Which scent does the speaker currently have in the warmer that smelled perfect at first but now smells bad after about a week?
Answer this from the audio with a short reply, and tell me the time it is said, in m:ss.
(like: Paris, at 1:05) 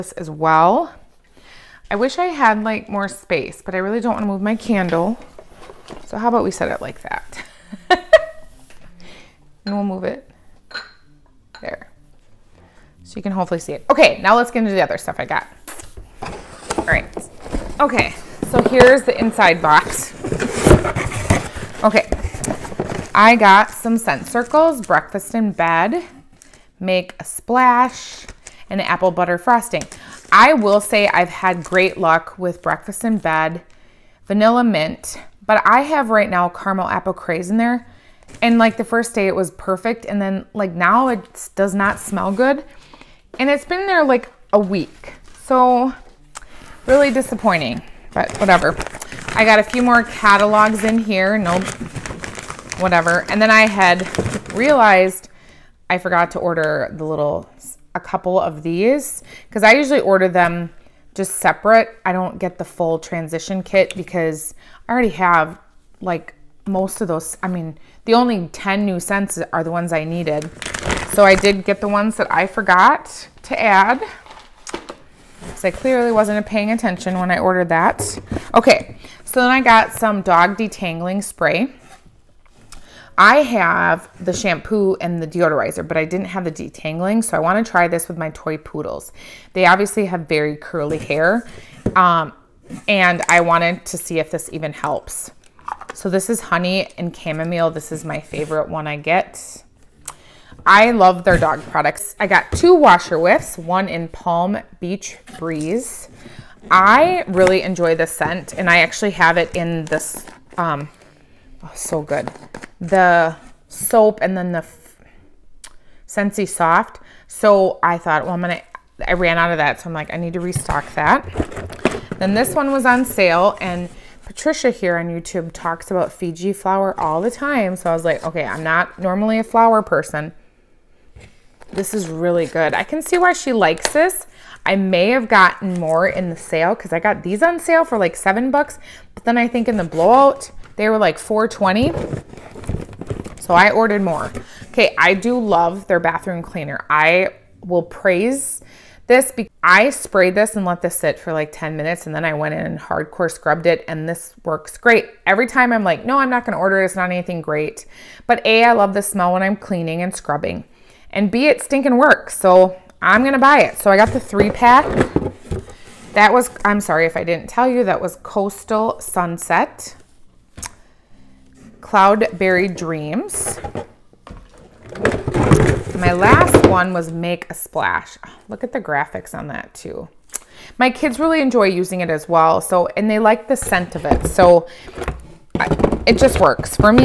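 Caramel Apple Craze, at 0:36.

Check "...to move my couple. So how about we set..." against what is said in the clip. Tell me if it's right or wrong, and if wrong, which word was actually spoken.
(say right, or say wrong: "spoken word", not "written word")
wrong: "candle", not "couple".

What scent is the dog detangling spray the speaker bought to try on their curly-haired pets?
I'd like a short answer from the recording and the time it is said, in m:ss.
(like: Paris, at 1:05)
Honey and Chamomile, at 1:36.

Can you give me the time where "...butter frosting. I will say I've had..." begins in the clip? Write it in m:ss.
0:29.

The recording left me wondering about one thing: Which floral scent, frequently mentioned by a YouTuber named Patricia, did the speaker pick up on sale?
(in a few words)
Fiji Flower.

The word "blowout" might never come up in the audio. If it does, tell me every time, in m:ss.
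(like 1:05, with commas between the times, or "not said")
2:19.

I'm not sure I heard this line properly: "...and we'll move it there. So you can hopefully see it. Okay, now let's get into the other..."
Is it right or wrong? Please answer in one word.
right.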